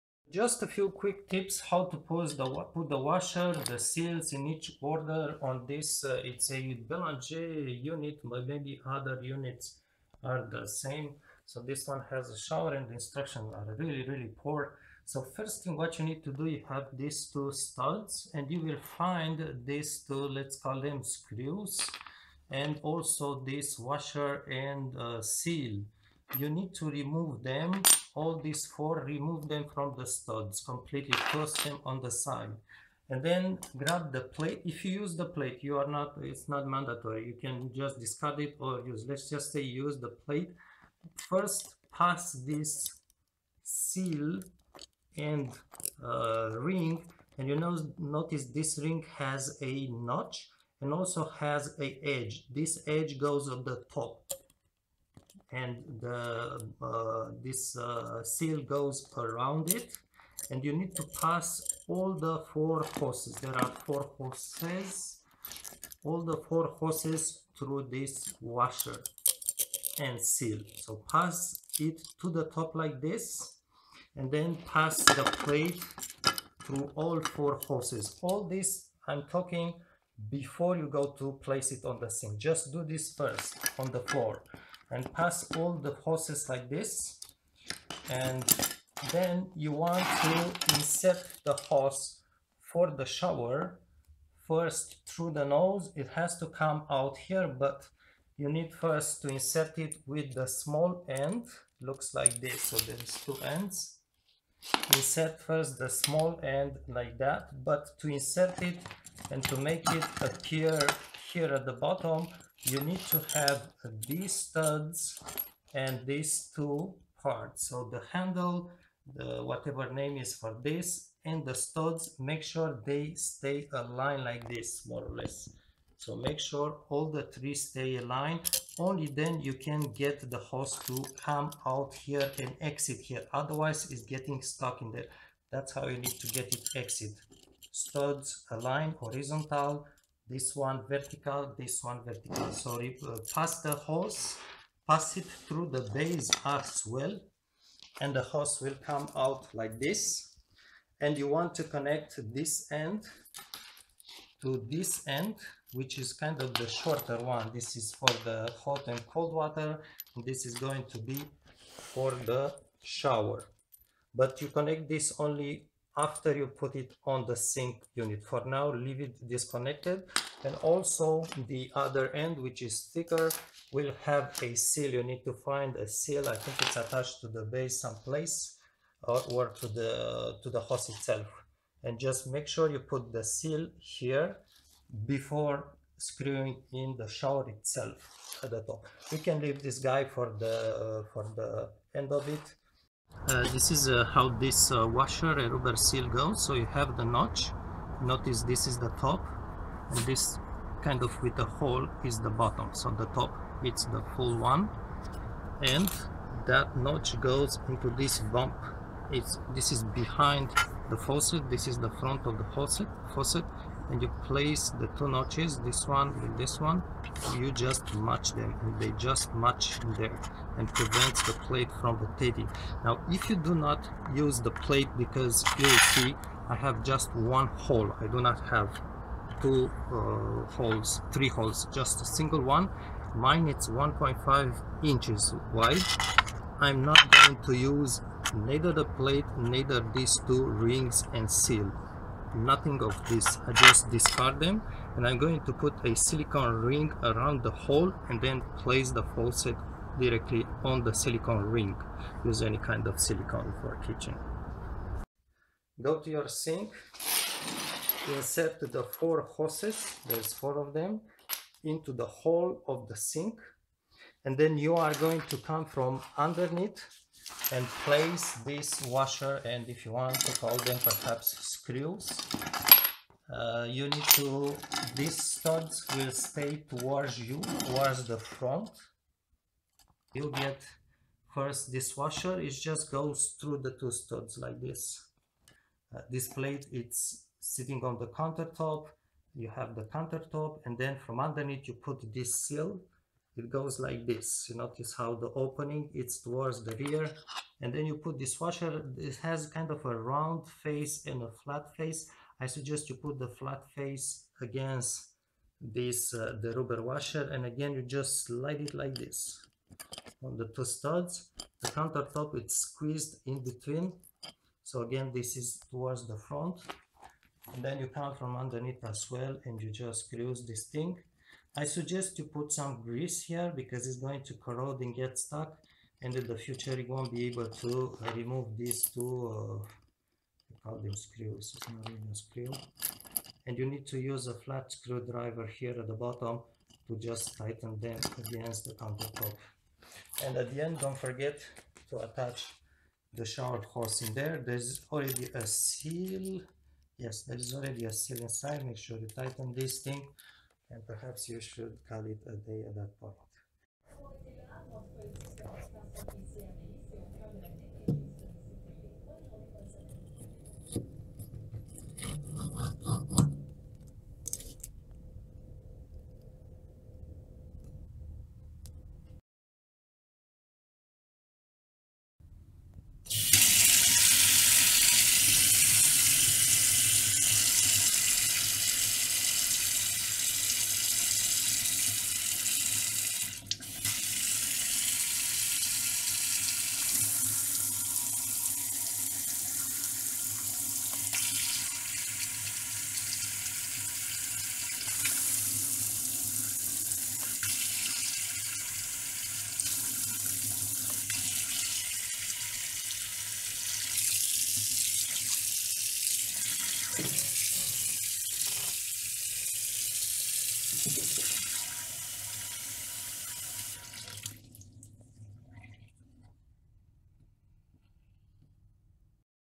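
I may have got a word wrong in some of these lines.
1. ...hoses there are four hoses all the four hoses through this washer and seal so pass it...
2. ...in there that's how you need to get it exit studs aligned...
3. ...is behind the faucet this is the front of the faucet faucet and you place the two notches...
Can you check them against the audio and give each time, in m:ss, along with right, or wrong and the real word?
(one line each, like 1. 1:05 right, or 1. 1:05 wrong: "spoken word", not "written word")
1. 1:02 right
2. 2:14 right
3. 3:29 right.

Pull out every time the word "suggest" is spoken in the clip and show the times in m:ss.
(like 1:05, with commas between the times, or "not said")
5:02, 5:21.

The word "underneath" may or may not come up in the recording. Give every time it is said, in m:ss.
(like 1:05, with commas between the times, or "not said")
4:26, 4:51, 5:18.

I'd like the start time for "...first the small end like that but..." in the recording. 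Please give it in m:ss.
1:45.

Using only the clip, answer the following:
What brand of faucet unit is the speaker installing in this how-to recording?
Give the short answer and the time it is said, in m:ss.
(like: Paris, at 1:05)
Belanger, at 0:06.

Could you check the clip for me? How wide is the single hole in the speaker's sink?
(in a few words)
1.5 inches.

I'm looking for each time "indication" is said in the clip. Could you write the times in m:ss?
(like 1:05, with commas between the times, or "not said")
not said.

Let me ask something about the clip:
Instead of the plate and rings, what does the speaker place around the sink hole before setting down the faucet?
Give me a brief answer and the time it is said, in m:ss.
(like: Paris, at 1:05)
A silicone ring, at 4:05.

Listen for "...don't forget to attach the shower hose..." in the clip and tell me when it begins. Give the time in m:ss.
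5:40.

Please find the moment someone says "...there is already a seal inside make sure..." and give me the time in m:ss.
5:47.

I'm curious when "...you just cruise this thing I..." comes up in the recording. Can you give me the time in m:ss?
5:19.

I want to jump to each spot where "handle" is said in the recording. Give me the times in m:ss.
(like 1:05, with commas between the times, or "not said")
1:58.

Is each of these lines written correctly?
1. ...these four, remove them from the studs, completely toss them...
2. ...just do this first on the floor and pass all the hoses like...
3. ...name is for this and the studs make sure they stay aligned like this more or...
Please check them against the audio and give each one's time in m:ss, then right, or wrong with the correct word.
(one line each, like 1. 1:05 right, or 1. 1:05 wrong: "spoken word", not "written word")
1. 0:28 right
2. 1:22 right
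3. 1:59 right.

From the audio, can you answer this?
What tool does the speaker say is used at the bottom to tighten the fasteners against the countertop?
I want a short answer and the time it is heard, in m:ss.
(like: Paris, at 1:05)
A flat screwdriver, at 5:34.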